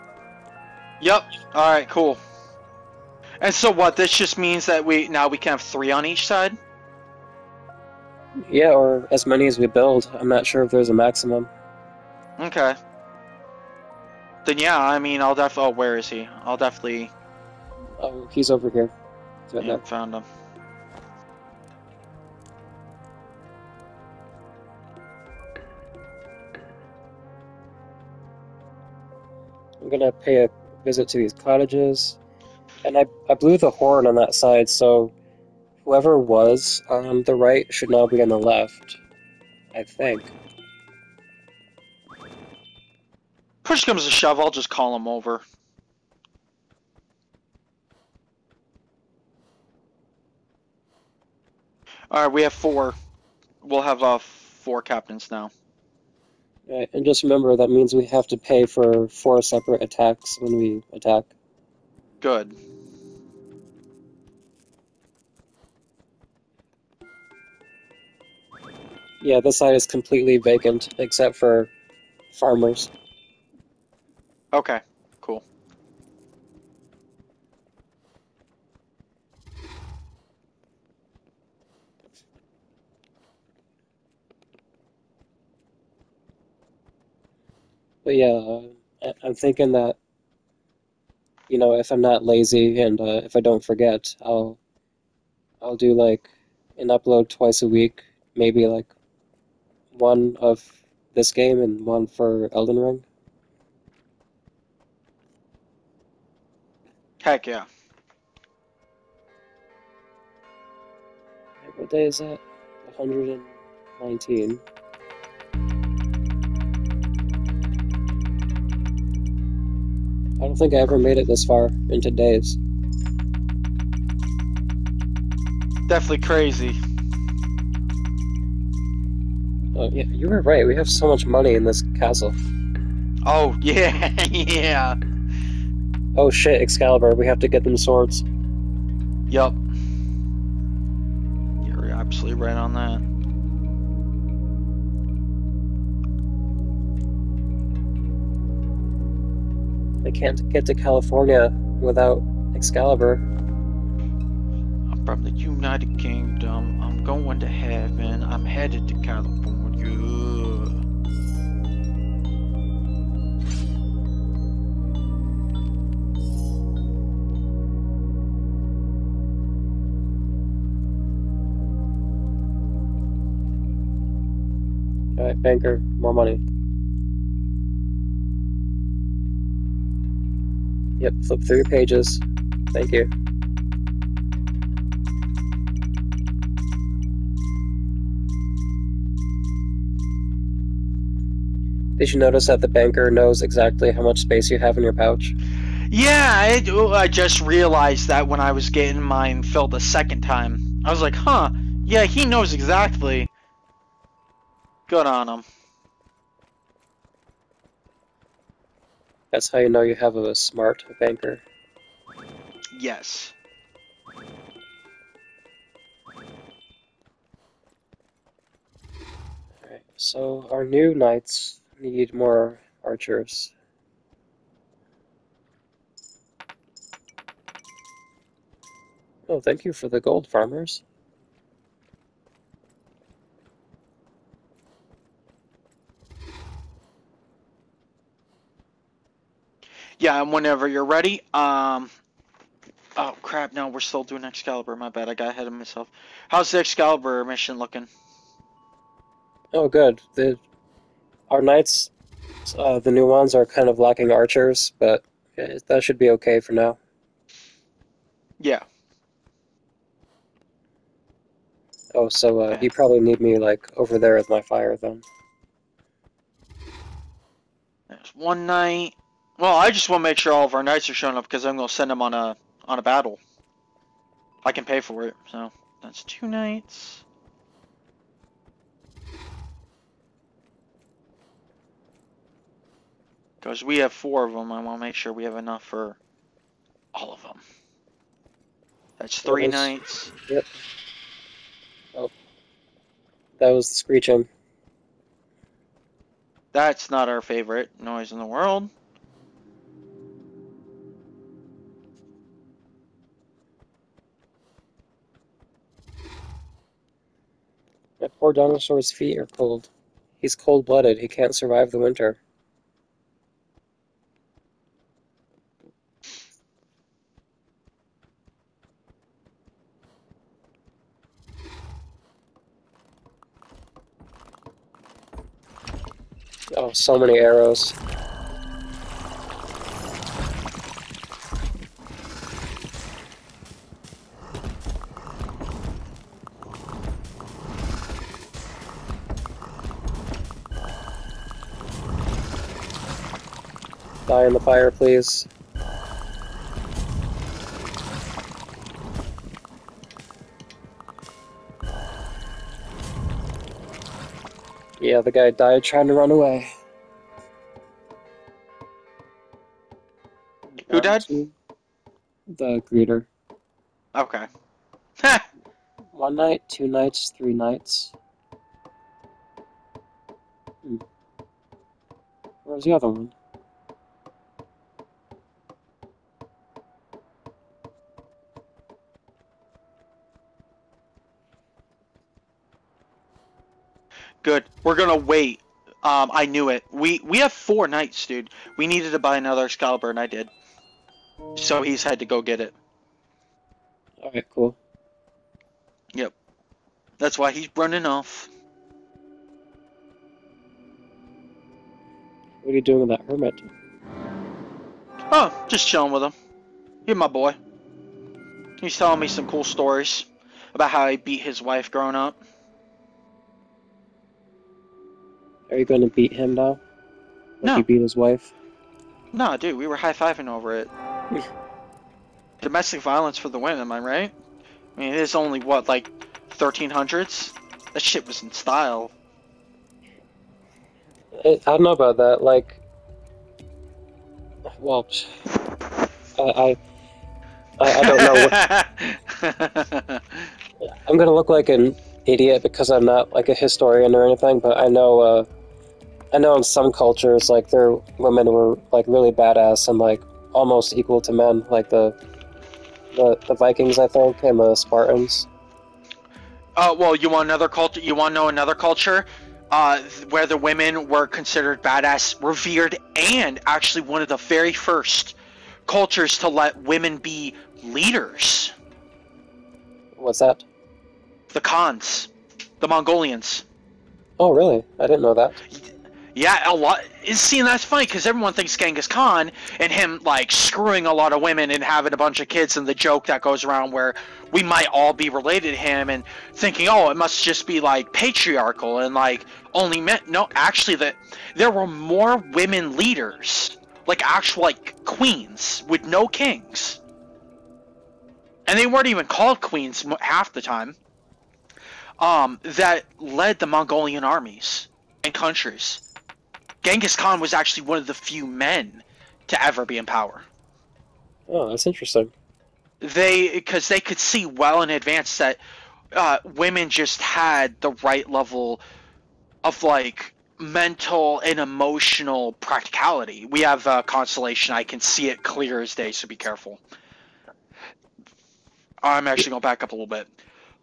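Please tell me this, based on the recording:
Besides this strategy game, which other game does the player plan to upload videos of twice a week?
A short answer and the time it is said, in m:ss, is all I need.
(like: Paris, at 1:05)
Elden Ring, at 1:42.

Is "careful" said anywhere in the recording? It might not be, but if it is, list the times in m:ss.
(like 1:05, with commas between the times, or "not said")
8:46.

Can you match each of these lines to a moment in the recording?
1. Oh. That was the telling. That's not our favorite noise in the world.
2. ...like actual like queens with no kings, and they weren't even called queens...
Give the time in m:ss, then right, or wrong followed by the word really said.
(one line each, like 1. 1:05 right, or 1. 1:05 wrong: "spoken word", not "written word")
1. 4:51 wrong: "screeching", not "telling"
2. 8:13 right.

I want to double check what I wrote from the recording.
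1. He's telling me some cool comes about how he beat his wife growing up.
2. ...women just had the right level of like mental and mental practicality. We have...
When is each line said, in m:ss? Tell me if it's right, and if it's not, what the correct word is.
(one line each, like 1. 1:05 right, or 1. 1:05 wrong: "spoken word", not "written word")
1. 6:48 wrong: "stories", not "comes"
2. 8:36 wrong: "emotional", not "mental".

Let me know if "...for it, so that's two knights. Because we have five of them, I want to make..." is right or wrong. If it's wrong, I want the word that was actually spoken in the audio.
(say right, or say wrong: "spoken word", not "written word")
wrong: "four", not "five".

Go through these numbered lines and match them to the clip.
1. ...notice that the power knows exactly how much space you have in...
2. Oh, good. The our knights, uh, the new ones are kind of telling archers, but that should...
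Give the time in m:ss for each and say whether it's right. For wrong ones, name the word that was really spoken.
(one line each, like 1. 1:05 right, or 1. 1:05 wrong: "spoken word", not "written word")
1. 3:12 wrong: "banker", not "power"
2. 4:09 wrong: "lacking", not "telling".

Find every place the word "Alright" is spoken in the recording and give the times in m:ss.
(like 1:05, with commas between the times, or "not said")
0:52, 2:55, 3:39, 6:34.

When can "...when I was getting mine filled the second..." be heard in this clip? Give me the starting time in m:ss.
3:18.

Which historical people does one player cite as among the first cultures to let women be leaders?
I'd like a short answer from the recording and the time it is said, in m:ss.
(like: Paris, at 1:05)
The Mongolians, at 7:52.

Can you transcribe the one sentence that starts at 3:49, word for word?
Oh, thank you for the gold, farmers.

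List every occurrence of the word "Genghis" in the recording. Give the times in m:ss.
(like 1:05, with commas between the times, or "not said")
7:58, 8:26.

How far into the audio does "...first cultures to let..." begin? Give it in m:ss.
7:44.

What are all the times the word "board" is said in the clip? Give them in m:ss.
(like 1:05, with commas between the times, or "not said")
not said.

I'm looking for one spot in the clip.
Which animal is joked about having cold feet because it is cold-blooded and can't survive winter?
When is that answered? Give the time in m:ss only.
5:08.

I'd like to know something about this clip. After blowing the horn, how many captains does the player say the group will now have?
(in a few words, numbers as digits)
4.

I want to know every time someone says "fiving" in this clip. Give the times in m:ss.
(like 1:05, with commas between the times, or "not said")
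6:59.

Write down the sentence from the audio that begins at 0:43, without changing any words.
Push comes to shove, I'll just call him over.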